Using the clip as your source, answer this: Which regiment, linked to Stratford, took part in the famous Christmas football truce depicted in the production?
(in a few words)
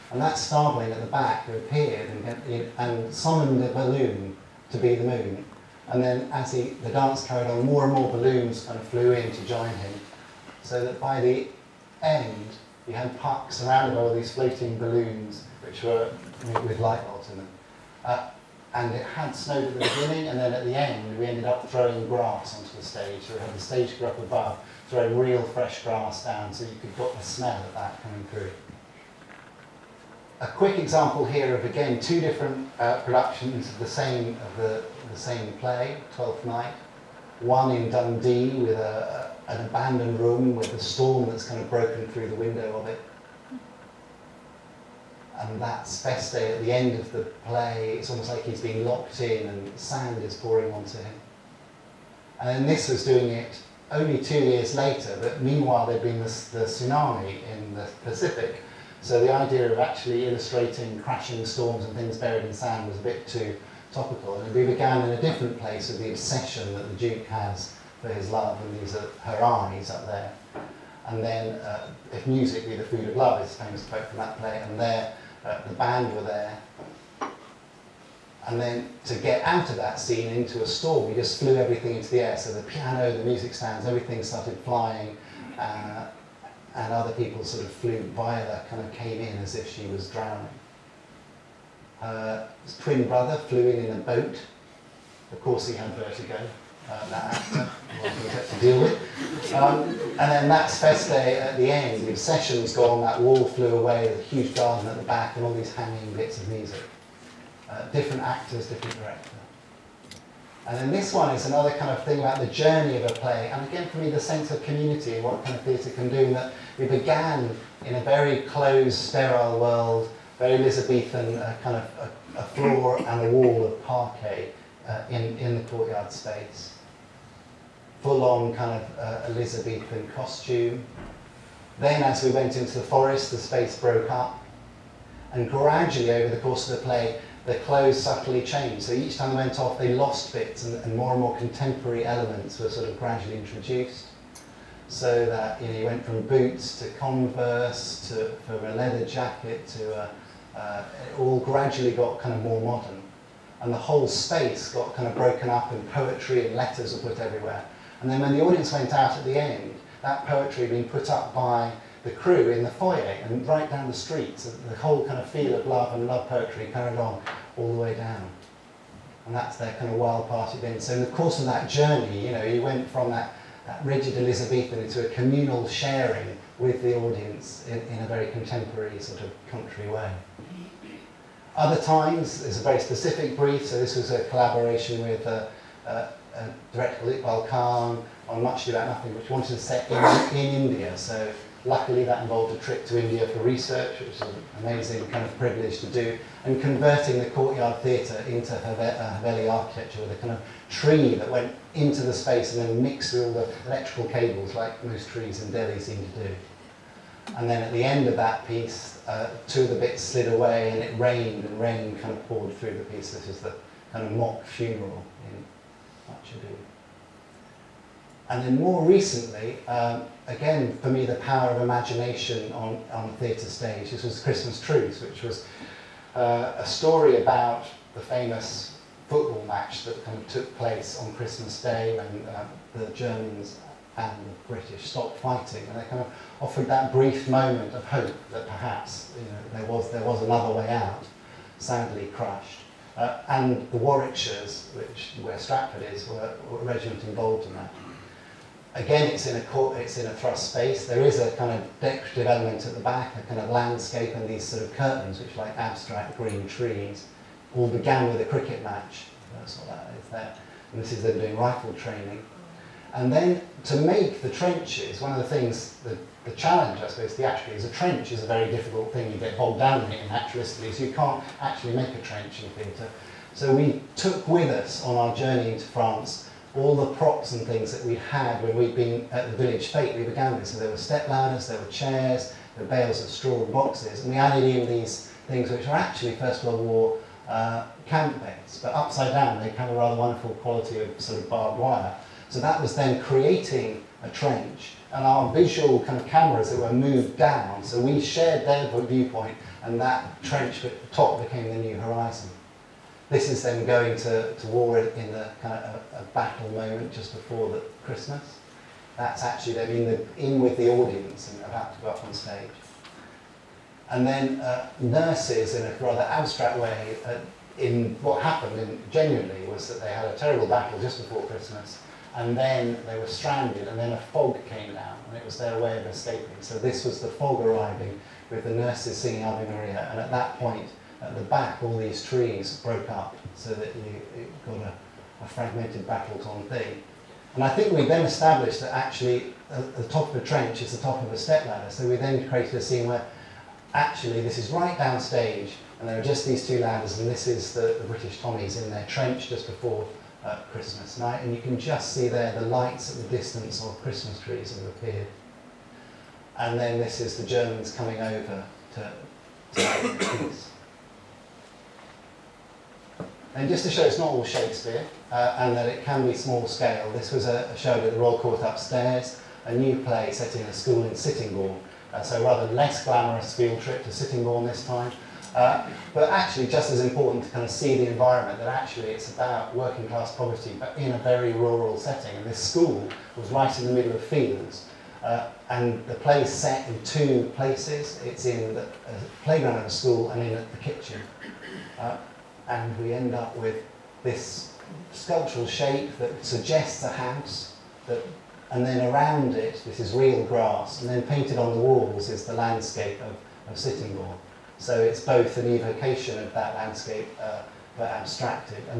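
The Warwickshires.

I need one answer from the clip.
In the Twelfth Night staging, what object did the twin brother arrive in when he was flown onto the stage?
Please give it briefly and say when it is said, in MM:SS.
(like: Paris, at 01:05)
A boat, at 01:33.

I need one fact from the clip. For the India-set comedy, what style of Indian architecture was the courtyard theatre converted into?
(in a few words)
Haveli.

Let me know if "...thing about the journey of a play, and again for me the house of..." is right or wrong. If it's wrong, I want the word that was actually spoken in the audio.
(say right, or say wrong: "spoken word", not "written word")
wrong: "sense", not "house".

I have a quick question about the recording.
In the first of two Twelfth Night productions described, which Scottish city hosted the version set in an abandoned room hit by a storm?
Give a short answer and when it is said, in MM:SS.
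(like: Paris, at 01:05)
Dundee, at 00:37.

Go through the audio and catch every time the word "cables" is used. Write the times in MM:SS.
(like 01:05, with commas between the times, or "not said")
03:24.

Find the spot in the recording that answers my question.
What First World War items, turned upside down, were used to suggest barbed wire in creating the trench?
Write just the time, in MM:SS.
04:47.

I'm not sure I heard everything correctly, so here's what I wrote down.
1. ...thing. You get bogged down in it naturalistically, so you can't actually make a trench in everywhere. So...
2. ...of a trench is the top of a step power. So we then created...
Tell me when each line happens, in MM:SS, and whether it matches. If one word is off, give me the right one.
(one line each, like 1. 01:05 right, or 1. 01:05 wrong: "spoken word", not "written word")
1. 04:28 wrong: "theatre", not "everywhere"
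2. 05:40 wrong: "ladder", not "power".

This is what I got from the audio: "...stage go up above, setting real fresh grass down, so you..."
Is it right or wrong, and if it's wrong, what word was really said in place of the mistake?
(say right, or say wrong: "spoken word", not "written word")
wrong: "throwing", not "setting".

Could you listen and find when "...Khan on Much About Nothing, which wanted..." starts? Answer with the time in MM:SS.
03:07.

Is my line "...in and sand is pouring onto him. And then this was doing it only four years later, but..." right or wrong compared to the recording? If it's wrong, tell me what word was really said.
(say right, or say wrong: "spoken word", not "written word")
wrong: "two", not "four".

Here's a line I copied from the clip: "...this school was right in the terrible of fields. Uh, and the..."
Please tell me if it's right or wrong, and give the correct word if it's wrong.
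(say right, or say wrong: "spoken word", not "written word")
wrong: "middle", not "terrible".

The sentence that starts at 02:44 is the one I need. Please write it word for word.
So the whole kind of feel of love and love poetry carried on all the way down.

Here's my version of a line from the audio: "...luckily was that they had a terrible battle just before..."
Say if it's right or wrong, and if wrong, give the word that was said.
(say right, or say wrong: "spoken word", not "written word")
wrong: "genuinely", not "luckily".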